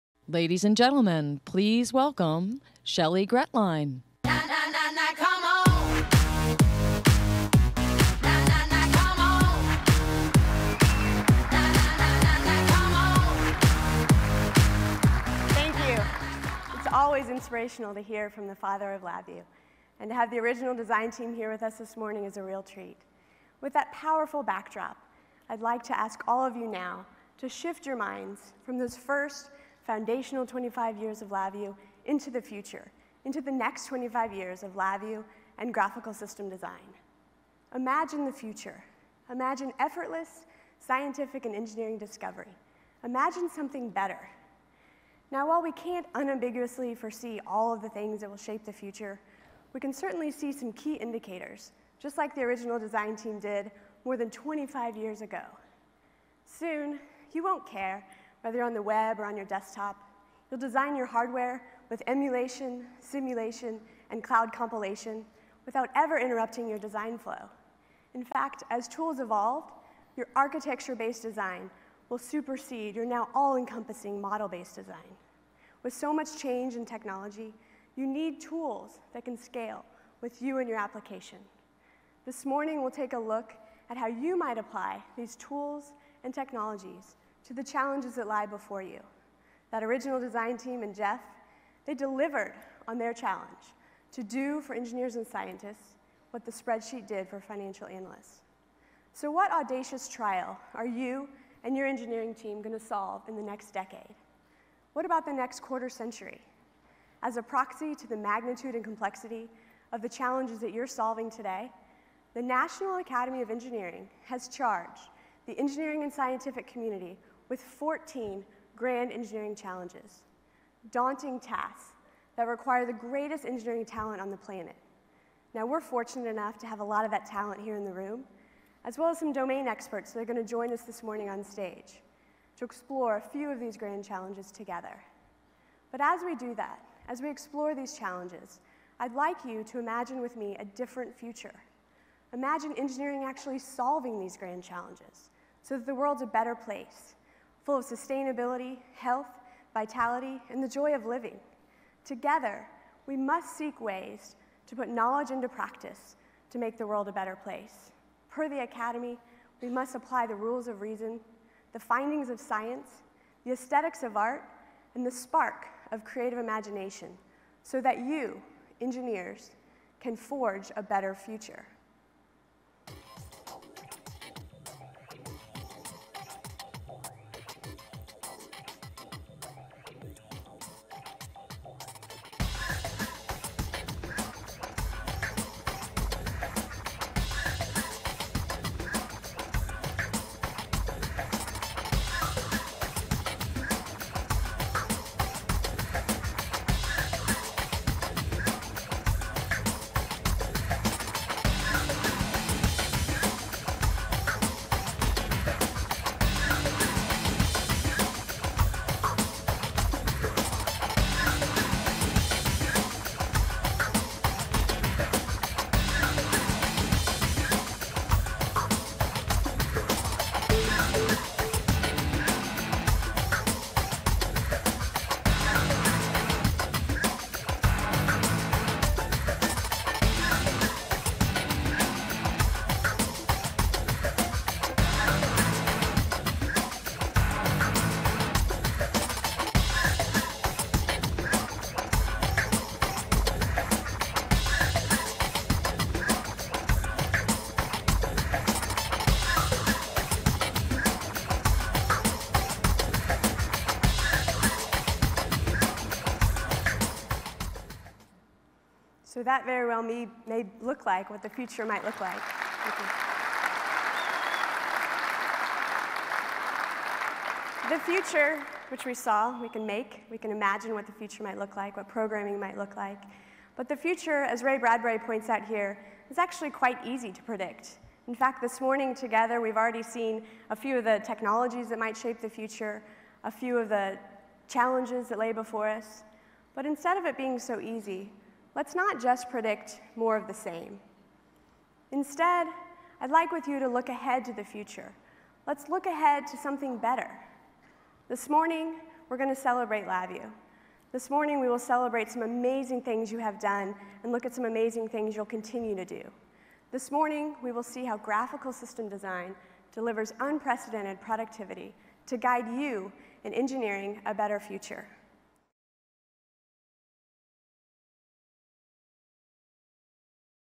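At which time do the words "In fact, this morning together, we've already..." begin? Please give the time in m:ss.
4:38.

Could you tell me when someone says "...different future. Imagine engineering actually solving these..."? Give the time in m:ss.
2:20.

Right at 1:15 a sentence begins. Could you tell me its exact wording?
With so much change in technology, you need tools that can scale with you and your application.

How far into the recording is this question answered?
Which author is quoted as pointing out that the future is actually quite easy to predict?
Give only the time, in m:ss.
4:34.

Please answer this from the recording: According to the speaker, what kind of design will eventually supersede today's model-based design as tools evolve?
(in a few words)
Architecture-based design.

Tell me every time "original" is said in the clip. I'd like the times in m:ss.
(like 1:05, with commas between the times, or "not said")
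0:20, 0:52, 1:29.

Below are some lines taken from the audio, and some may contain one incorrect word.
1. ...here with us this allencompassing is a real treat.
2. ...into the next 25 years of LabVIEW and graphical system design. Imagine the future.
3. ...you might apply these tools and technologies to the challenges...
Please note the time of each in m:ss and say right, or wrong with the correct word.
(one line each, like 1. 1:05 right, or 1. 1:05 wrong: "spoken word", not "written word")
1. 0:21 wrong: "morning", not "allencompassing"
2. 0:33 right
3. 1:24 right.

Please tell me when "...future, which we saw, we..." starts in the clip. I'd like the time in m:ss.
4:27.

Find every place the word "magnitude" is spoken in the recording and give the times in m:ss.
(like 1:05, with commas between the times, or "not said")
1:48.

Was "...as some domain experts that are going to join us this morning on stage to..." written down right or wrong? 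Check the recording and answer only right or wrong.
right.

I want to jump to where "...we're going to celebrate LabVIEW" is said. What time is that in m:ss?
4:59.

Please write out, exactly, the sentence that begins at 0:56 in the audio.
Soon, you won't care whether on the web or on your desktop.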